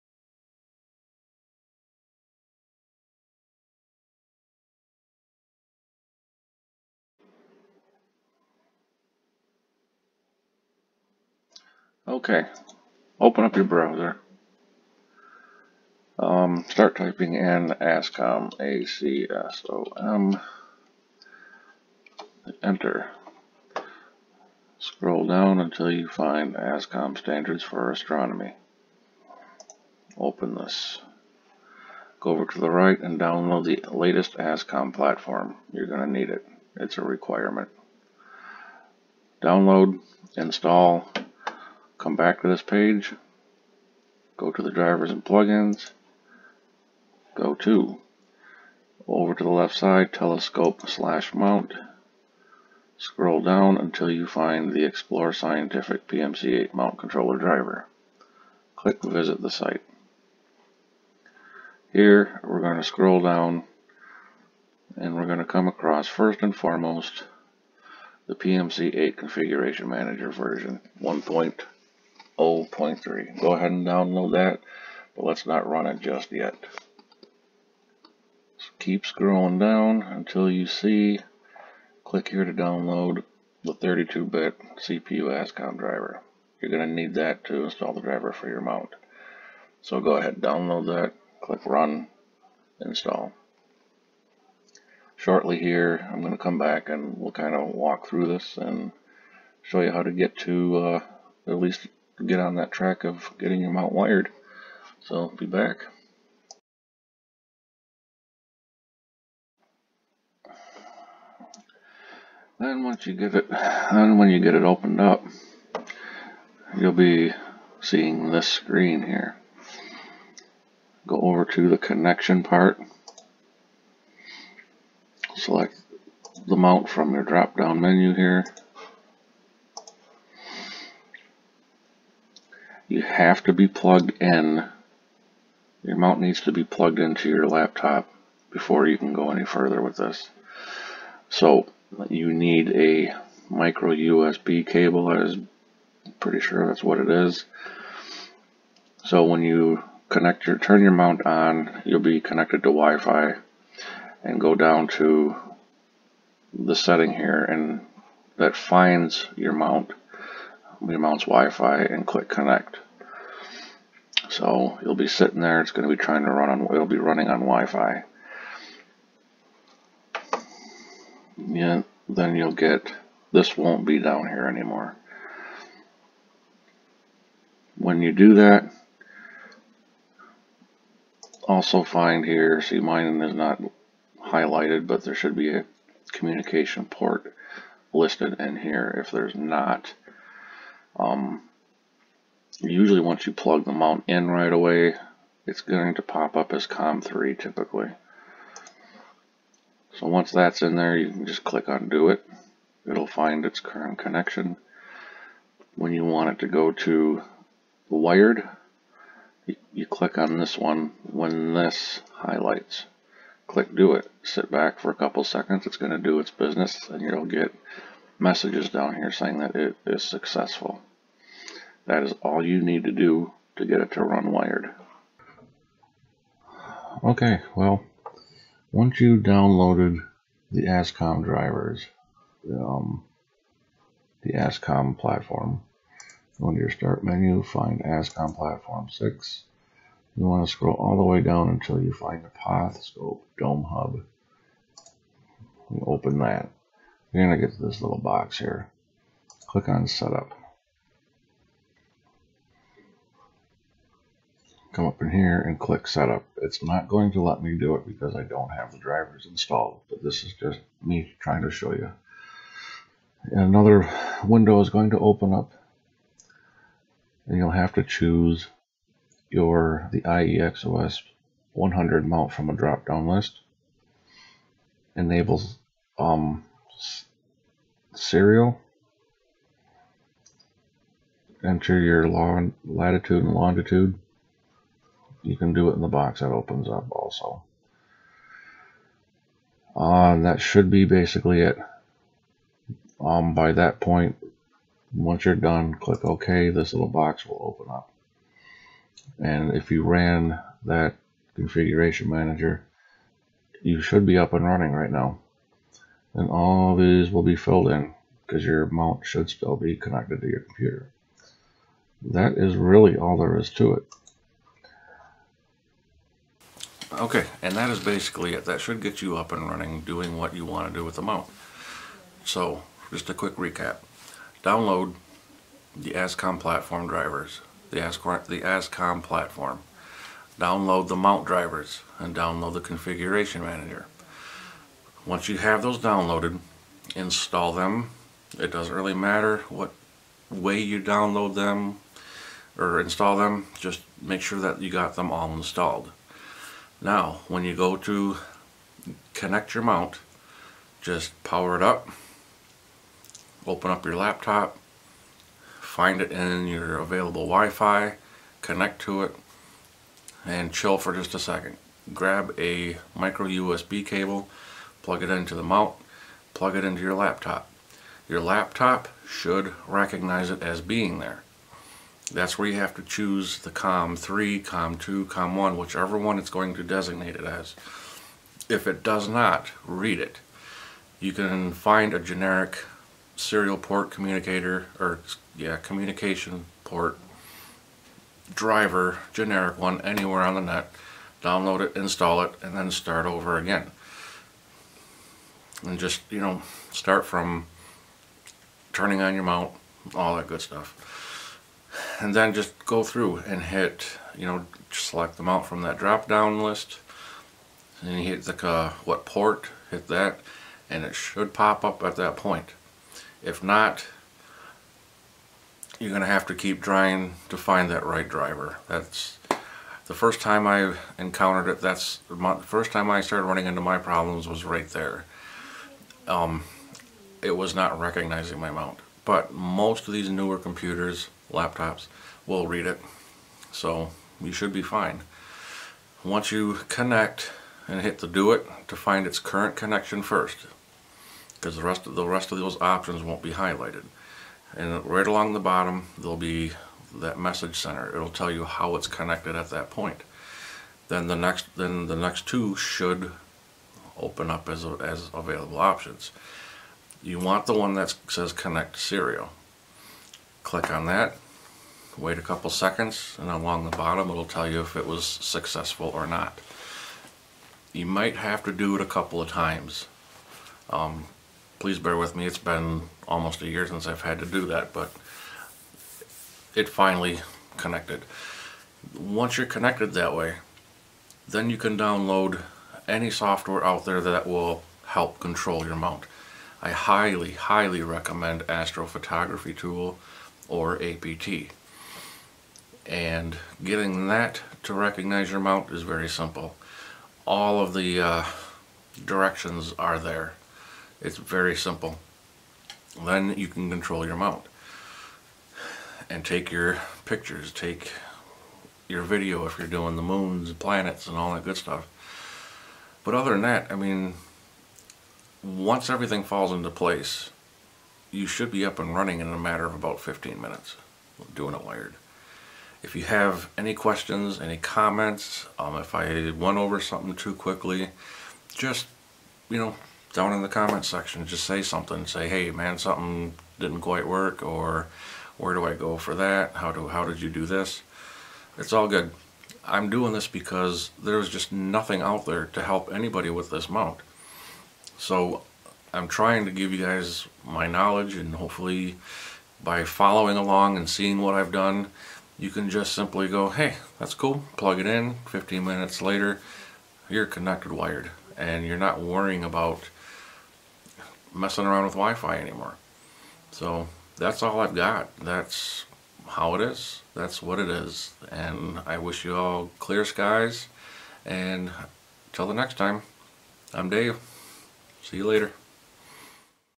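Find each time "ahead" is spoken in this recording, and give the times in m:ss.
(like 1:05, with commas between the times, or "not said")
1:13, 1:30.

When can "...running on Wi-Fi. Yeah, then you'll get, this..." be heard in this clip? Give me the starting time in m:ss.
2:46.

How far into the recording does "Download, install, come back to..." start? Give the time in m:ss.
0:39.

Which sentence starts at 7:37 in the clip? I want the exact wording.
You want the one that says connect serial.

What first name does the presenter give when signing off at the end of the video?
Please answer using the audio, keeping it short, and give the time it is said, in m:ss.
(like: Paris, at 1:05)
Dave, at 9:33.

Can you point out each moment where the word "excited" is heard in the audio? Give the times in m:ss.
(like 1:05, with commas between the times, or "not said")
not said.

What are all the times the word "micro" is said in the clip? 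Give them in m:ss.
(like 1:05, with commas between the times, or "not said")
2:23, 6:02.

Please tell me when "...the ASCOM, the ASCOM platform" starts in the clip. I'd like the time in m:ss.
5:27.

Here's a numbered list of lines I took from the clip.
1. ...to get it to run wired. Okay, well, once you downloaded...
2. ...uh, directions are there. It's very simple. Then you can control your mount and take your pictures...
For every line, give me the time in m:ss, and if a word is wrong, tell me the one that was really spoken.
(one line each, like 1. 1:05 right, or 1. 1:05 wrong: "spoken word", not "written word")
1. 3:43 right
2. 8:18 right.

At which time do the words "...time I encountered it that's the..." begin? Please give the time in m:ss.
7:00.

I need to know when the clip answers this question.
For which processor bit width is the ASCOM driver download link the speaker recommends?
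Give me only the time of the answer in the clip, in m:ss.
1:23.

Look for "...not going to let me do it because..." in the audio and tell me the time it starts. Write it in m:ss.
4:16.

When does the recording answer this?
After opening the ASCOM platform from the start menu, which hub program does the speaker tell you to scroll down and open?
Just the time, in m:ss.
4:02.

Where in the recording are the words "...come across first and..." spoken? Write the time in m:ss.
1:05.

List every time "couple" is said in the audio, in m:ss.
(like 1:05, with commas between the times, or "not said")
3:34, 7:42, 7:48.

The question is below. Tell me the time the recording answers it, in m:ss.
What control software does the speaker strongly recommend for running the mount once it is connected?
8:08.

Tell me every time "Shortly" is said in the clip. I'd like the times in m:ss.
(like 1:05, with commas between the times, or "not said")
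1:35.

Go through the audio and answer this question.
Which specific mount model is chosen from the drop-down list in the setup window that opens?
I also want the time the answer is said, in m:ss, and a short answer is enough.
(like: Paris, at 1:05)
iEXOS 100, at 4:30.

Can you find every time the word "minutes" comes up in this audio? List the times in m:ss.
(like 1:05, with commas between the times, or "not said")
8:40, 9:15.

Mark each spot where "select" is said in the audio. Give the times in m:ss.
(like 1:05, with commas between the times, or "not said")
2:05, 6:44.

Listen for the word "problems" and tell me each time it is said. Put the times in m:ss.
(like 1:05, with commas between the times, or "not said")
7:03.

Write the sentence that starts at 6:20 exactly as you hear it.
You can find a generic serial port communicator, or yeah, communication port driver, generic one, anywhere on the net.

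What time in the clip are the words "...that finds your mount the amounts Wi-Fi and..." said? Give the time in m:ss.
2:38.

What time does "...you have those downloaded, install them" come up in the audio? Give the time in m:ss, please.
5:35.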